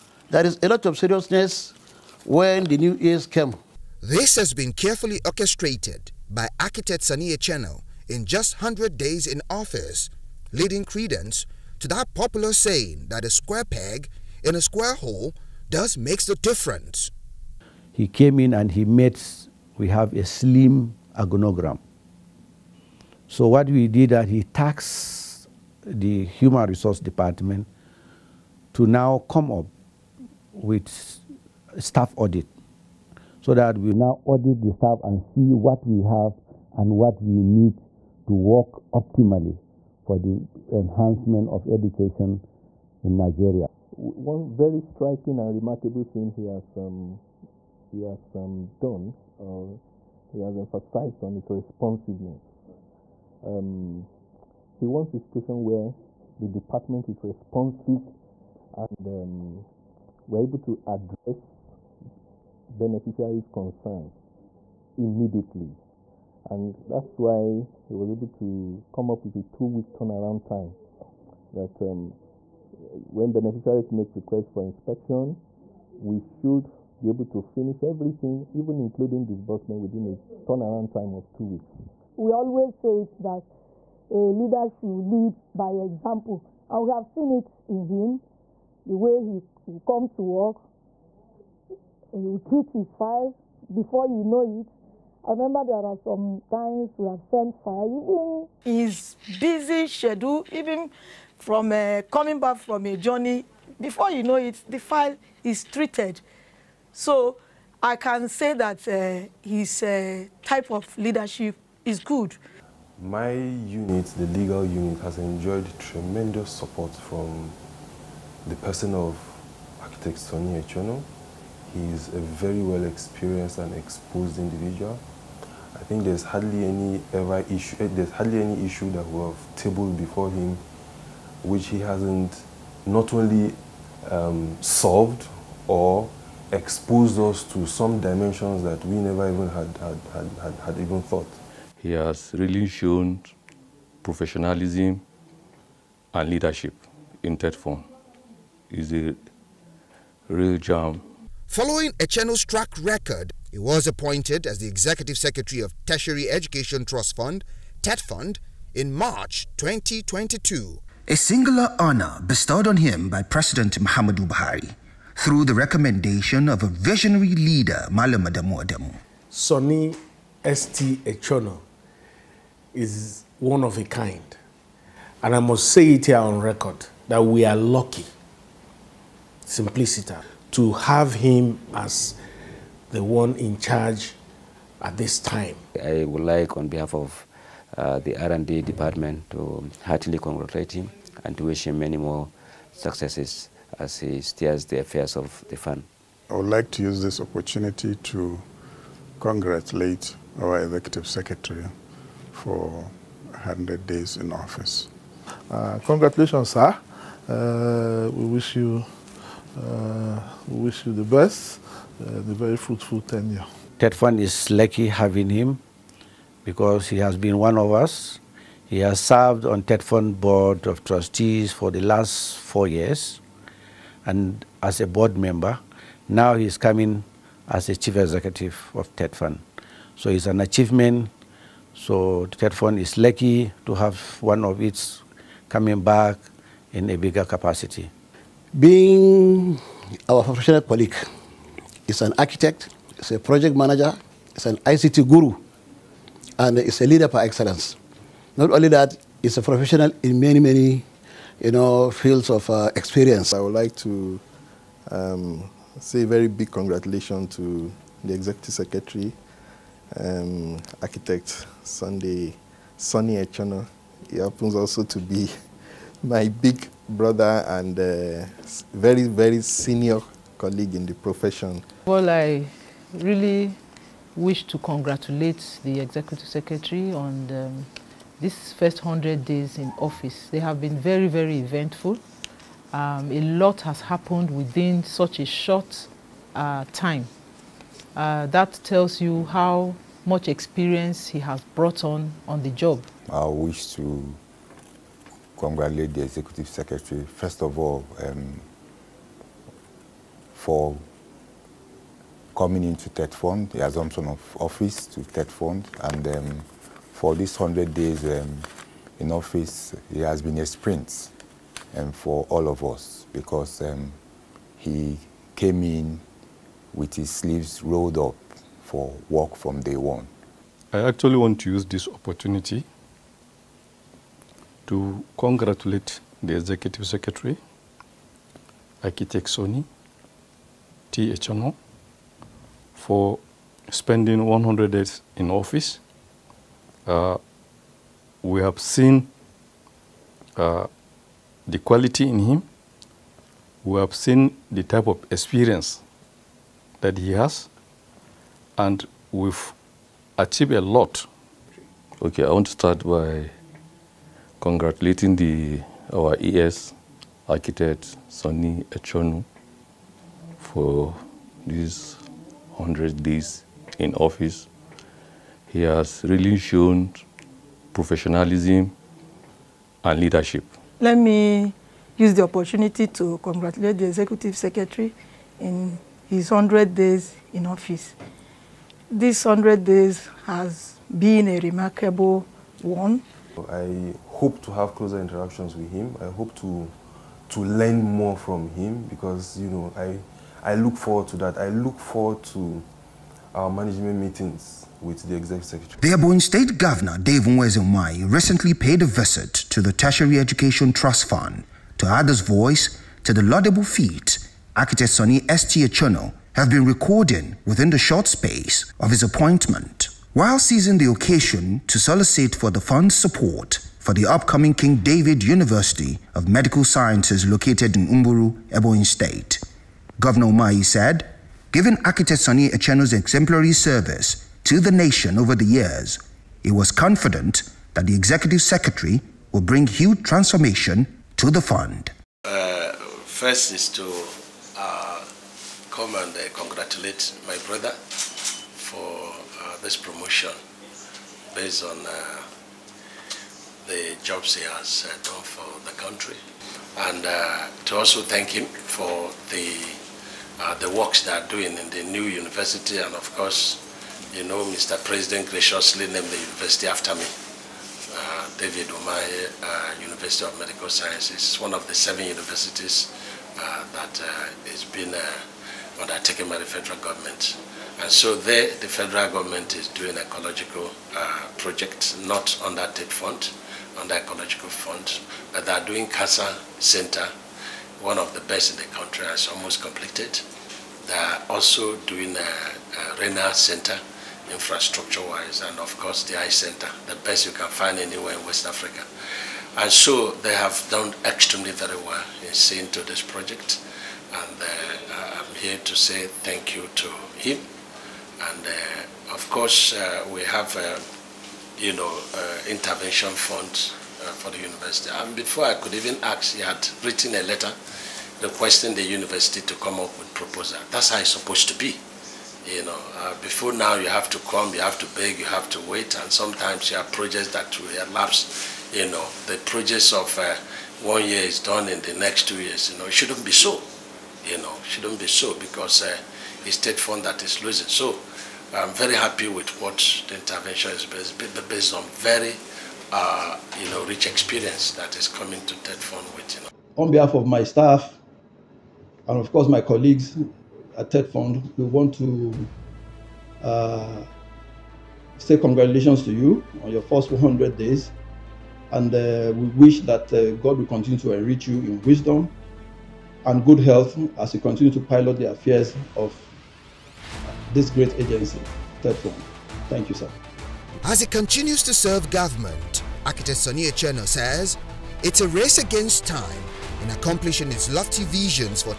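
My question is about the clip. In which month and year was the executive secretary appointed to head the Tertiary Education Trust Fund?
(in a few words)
March 2022.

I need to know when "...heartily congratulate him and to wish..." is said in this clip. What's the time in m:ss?
3:09.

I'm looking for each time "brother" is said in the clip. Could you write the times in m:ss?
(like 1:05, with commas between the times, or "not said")
4:26, 7:17.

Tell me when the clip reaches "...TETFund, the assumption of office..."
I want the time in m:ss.
5:02.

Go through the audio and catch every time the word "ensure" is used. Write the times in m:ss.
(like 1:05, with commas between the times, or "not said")
not said.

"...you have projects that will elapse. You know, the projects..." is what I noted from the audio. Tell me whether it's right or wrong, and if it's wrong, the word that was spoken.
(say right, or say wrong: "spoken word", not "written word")
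right.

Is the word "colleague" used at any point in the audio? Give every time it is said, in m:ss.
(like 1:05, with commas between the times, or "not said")
4:00, 4:30, 8:59.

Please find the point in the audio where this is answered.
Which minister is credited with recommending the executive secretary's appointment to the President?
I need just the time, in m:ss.
2:47.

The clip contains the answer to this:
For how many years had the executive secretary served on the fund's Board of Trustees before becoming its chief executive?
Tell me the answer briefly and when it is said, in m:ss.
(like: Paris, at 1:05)
4 years, at 3:42.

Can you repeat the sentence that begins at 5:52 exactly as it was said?
Okay, I want to start by congratulating the our ES architect Sonny Echono for these 100 days in office.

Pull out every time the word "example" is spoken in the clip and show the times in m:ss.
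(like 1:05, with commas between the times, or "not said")
1:25.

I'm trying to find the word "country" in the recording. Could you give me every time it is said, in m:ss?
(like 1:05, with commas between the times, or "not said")
7:25, 7:58.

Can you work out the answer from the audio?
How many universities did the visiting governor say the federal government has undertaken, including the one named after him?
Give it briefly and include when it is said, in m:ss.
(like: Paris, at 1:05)
7, at 7:41.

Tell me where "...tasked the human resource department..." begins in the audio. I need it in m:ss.
0:24.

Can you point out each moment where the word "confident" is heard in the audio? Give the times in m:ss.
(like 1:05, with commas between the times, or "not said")
7:06.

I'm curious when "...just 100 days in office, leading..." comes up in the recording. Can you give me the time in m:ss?
0:08.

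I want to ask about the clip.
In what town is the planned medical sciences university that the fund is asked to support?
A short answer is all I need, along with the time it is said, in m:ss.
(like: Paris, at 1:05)
Uburu, at 6:57.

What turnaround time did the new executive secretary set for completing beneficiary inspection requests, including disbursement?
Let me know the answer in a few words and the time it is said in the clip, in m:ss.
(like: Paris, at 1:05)
2 weeks, at 1:09.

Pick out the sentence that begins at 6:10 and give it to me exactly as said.
Let me use the opportunity to congratulate the Executive Secretary in his 100 days in office.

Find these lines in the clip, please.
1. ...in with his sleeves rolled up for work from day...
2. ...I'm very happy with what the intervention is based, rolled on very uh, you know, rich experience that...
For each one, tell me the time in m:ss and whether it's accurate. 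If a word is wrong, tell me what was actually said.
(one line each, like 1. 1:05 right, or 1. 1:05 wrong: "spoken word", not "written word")
1. 5:15 right
2. 8:48 wrong: "based", not "rolled".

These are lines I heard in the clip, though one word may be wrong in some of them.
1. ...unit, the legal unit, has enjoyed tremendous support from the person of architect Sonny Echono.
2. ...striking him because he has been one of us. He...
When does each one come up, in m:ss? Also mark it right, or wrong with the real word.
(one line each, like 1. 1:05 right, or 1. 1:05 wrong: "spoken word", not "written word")
1. 1:53 right
2. 3:34 wrong: "having", not "striking".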